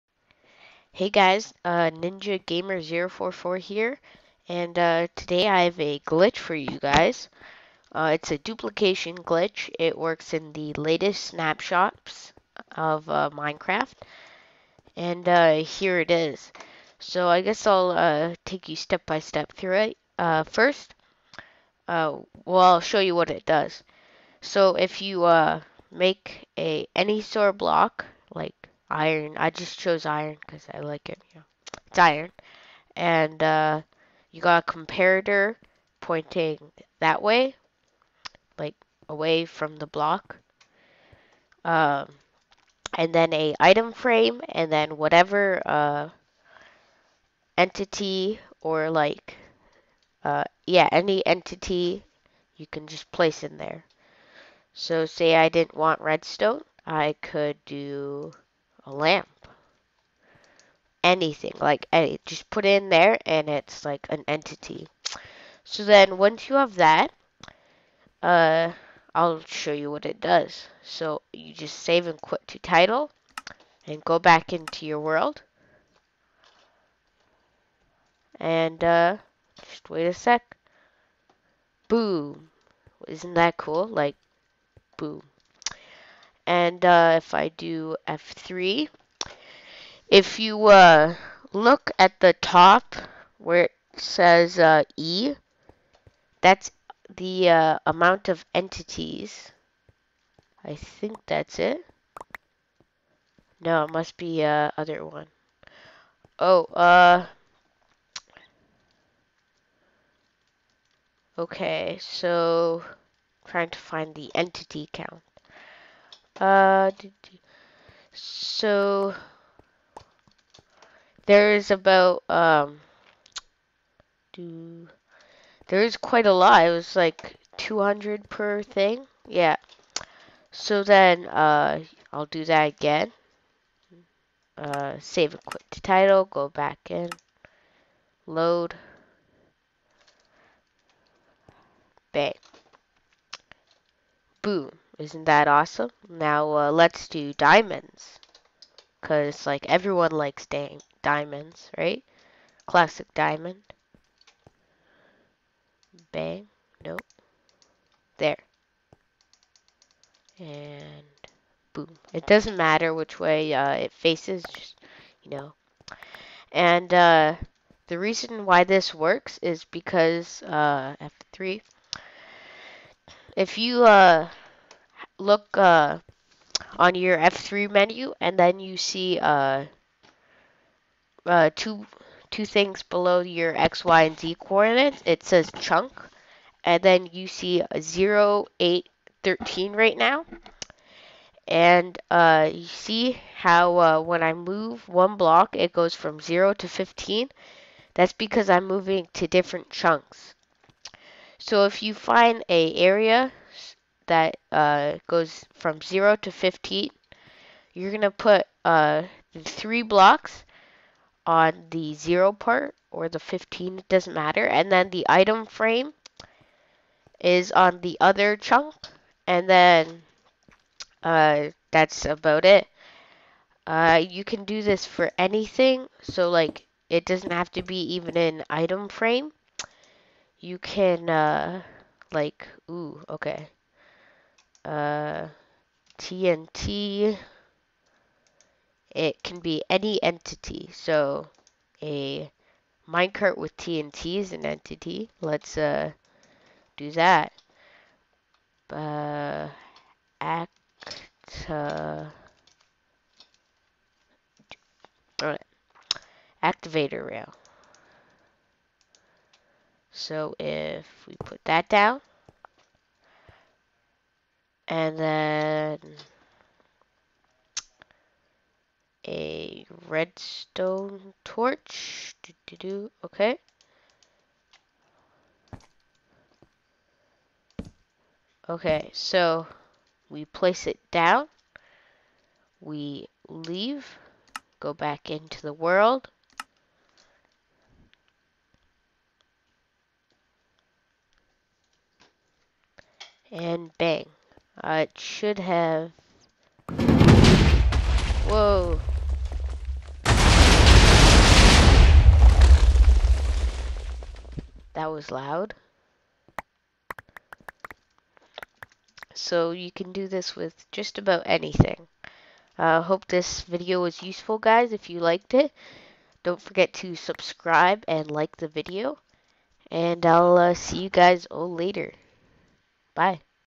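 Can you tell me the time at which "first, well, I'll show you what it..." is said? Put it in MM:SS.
00:20.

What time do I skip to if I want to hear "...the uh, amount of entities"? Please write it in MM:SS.
01:37.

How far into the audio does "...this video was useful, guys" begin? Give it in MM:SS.
05:13.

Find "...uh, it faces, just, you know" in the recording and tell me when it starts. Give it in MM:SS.
02:43.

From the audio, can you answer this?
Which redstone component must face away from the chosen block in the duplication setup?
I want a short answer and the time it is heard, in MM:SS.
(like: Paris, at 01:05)
comparator, at 00:34.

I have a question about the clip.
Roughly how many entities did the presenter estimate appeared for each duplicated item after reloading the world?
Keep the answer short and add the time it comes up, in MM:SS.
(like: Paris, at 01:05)
200, at 02:07.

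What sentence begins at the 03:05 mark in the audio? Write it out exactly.
It says chunk, and then you see 0, 8, 13 right now.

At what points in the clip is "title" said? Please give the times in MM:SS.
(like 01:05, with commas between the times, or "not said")
01:12, 02:15.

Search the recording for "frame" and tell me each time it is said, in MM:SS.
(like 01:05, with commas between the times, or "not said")
00:43, 03:35, 03:48.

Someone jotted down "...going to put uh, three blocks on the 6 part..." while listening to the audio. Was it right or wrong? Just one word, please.
wrong.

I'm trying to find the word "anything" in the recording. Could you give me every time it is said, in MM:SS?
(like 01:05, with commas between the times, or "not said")
01:01, 03:45, 05:11.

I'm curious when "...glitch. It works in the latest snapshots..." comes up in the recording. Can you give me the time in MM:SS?
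00:09.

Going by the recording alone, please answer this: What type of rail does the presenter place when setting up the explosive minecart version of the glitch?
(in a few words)
activator rail.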